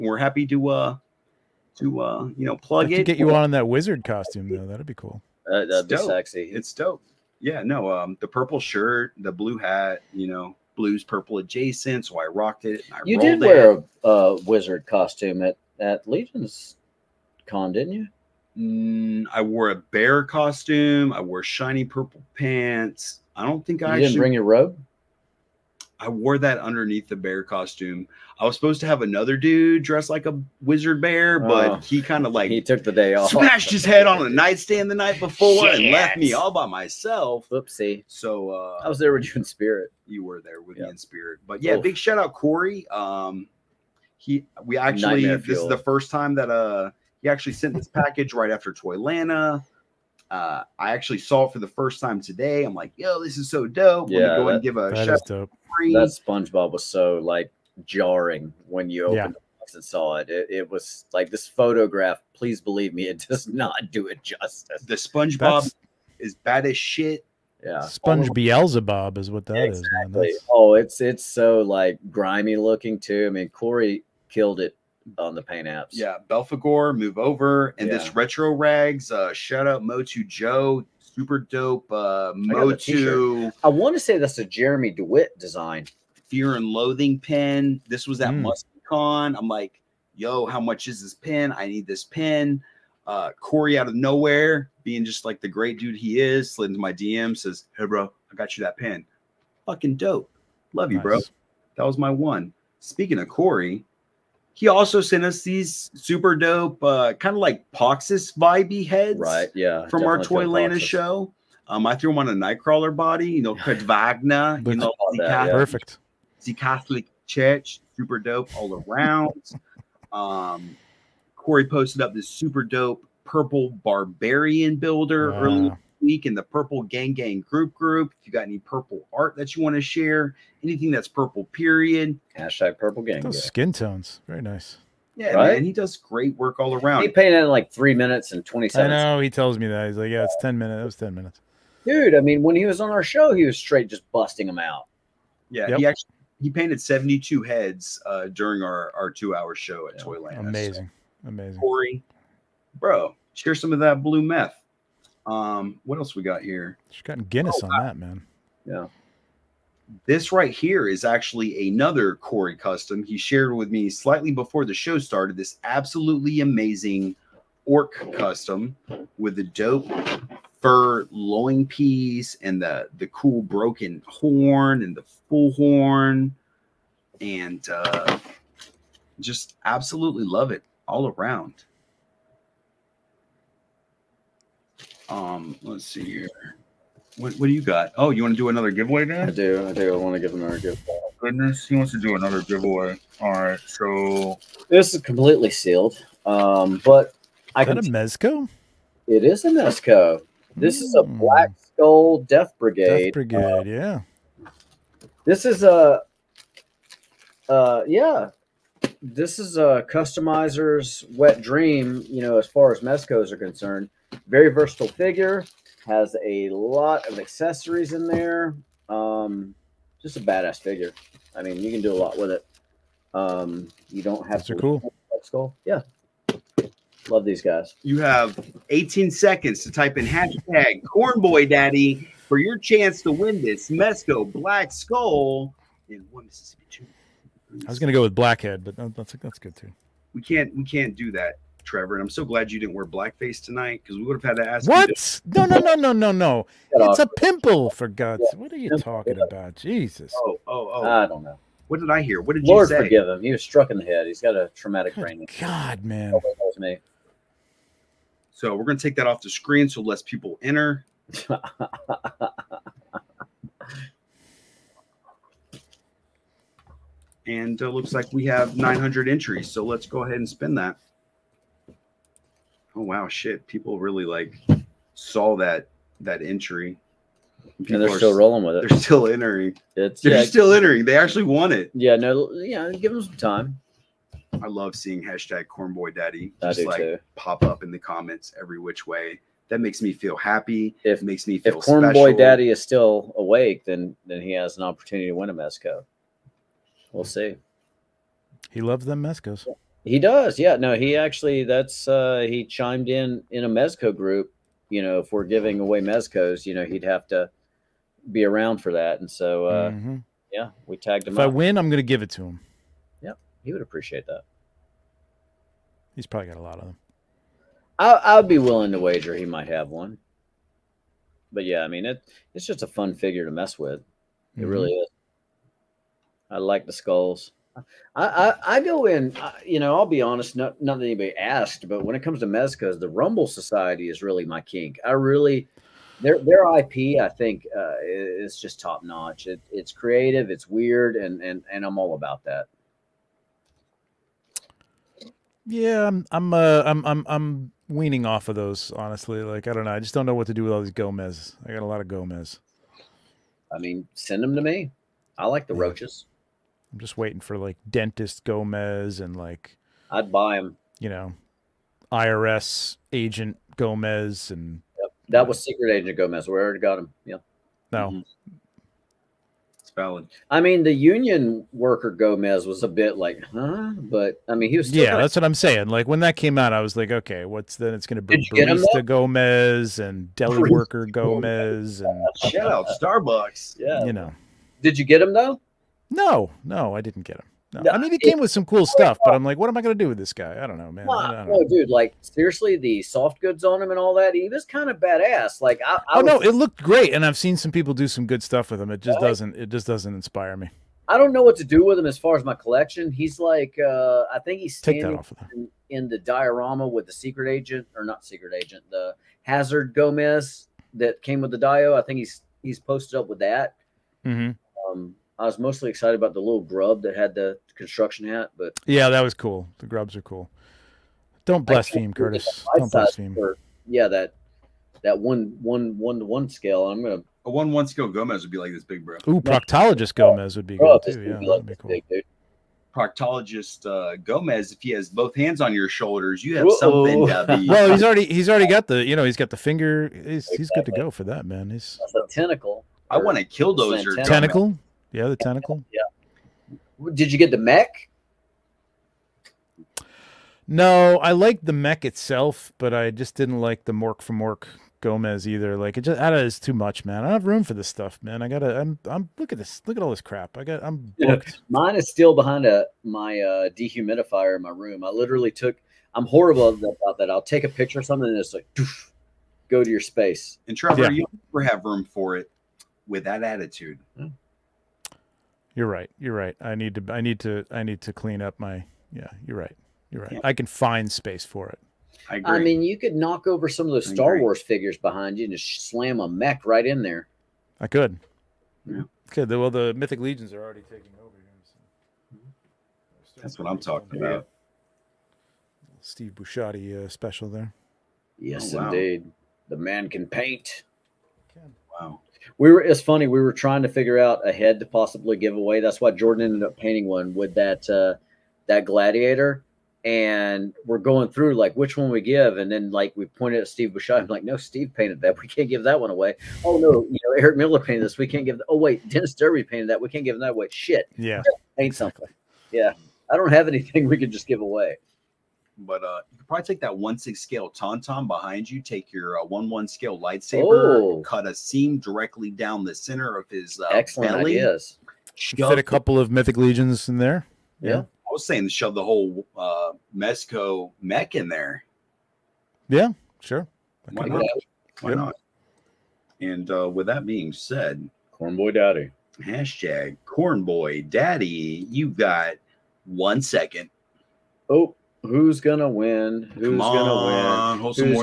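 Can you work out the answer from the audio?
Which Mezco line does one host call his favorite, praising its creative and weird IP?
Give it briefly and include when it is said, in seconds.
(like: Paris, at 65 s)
Rumble Society, at 332 s.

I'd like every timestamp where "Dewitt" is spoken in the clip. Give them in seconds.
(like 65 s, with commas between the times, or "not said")
84 s.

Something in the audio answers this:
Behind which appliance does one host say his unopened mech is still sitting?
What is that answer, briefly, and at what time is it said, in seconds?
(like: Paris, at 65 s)
Dehumidifier, at 463 s.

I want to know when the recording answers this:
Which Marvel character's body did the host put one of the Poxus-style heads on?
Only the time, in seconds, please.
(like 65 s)
112 s.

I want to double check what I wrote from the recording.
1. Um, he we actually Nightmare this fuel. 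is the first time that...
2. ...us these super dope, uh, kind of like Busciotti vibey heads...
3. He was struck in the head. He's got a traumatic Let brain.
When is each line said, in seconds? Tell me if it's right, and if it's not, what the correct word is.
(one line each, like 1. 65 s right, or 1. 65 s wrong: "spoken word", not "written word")
1. 42 s right
2. 105 s wrong: "Poxus", not "Busciotti"
3. 253 s wrong: "Good", not "Let".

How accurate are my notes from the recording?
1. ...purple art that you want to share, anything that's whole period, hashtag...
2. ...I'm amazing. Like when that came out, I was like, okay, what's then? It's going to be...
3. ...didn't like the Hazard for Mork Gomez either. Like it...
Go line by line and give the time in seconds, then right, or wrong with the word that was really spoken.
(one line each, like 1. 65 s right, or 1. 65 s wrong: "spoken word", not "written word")
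1. 128 s wrong: "purple", not "whole"
2. 375 s wrong: "saying", not "amazing"
3. 453 s wrong: "Mork", not "Hazard".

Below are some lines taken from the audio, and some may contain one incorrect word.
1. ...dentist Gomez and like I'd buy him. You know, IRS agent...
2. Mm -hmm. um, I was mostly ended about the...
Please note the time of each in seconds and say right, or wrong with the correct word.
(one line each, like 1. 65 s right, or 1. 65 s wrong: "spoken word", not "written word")
1. 357 s right
2. 414 s wrong: "excited", not "ended".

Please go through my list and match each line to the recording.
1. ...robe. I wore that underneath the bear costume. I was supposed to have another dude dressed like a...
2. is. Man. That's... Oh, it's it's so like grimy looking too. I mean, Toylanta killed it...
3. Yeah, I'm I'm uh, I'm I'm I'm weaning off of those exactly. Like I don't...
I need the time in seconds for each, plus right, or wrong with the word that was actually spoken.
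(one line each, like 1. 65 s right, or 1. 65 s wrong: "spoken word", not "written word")
1. 24 s right
2. 69 s wrong: "Corey", not "Toylanta"
3. 345 s wrong: "honestly", not "exactly".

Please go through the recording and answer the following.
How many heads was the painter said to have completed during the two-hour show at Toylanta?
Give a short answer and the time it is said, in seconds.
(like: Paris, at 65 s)
72, at 146 s.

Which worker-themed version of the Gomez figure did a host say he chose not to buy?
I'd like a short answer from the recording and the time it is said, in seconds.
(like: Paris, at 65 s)
Union worker Gomez, at 370 s.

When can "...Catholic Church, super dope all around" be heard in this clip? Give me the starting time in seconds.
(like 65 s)
116 s.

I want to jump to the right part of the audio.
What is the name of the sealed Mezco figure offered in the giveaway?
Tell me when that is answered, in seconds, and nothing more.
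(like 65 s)
201 s.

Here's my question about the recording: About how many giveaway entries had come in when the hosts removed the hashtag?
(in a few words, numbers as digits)
900.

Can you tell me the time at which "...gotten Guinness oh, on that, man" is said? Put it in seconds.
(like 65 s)
157 s.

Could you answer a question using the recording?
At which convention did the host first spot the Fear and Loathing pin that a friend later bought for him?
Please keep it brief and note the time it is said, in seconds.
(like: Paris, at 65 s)
MuskCon, at 88 s.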